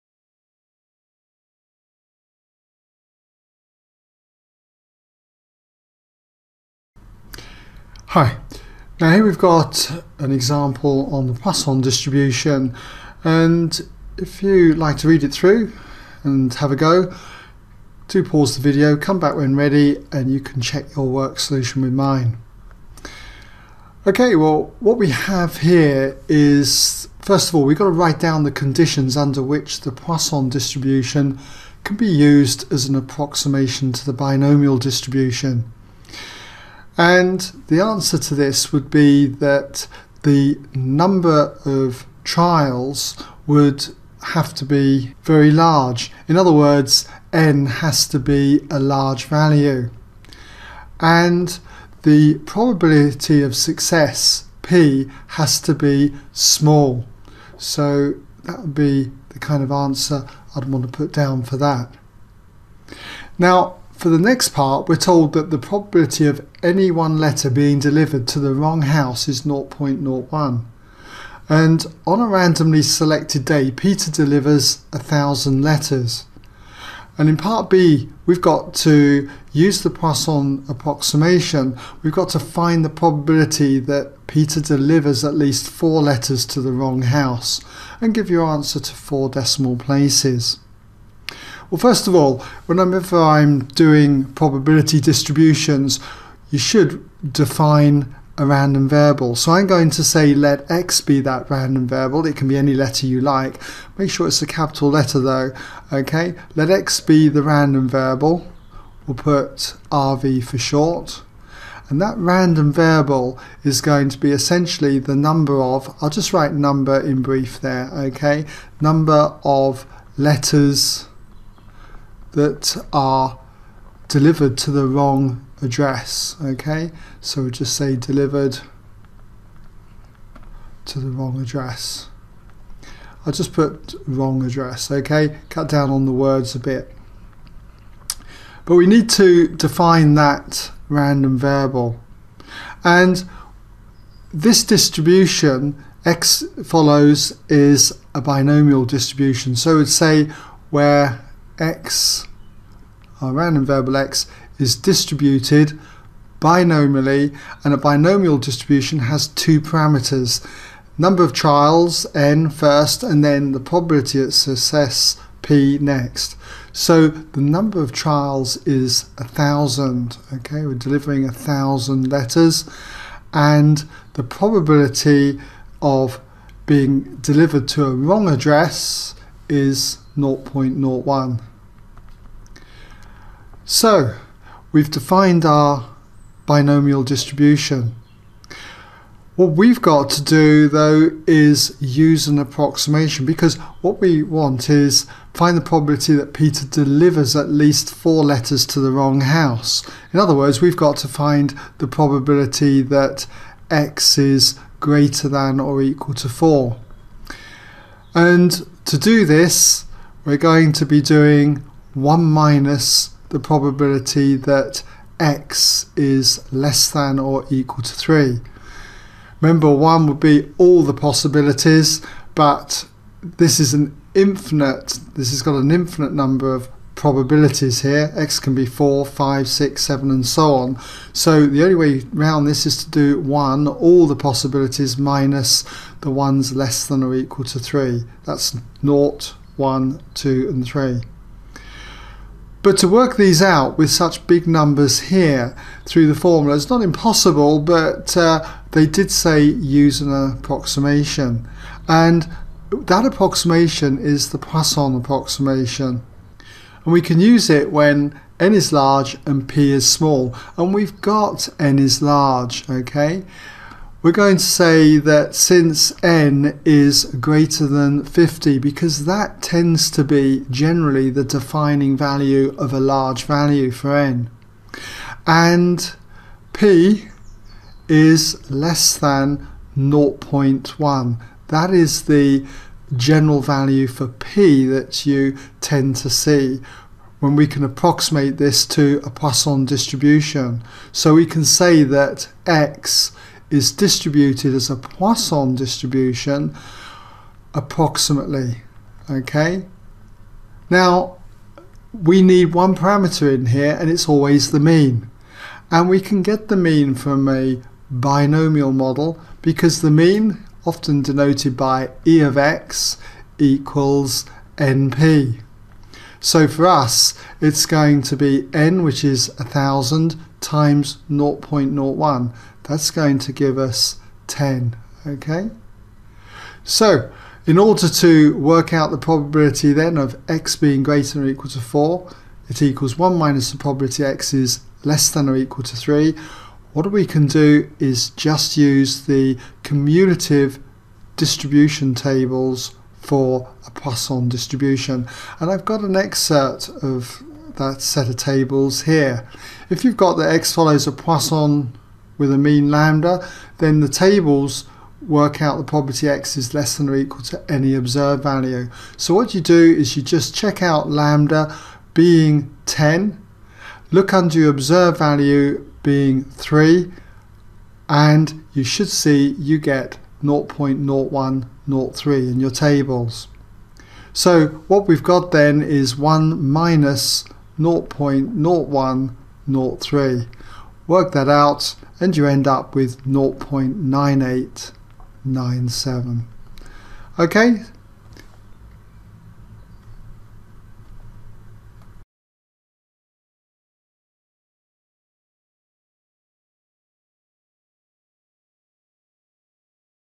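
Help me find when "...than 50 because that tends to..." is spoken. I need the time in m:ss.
4:27.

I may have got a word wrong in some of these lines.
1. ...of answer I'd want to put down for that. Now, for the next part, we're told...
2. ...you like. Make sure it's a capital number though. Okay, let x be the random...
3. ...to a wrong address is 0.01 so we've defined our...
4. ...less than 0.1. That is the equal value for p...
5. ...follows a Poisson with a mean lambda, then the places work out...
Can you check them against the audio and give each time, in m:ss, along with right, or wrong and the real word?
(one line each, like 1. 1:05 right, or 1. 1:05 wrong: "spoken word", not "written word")
1. 0:59 right
2. 1:43 wrong: "letter", not "number"
3. 2:57 right
4. 4:38 wrong: "general", not "equal"
5. 5:50 wrong: "tables", not "places".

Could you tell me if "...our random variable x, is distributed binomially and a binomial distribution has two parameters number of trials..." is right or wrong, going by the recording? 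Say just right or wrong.
right.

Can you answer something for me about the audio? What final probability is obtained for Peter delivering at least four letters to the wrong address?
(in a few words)
0.9897.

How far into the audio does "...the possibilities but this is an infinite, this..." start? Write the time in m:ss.
3:40.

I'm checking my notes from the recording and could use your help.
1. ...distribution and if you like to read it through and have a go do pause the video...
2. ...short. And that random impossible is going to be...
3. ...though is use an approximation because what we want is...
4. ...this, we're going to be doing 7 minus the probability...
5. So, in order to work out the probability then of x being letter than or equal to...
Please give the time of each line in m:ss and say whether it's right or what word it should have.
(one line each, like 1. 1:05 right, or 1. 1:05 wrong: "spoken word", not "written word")
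1. 0:11 right
2. 1:50 wrong: "variable", not "impossible"
3. 3:10 right
4. 3:29 wrong: "1", not "7"
5. 5:26 wrong: "greater", not "letter".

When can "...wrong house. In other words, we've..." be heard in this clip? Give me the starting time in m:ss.
3:18.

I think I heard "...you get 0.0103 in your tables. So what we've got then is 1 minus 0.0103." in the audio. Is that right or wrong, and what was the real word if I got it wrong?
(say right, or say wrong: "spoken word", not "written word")
right.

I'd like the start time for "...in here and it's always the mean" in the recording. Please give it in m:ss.
5:03.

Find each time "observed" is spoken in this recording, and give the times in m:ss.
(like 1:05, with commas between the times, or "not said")
5:57, 6:04.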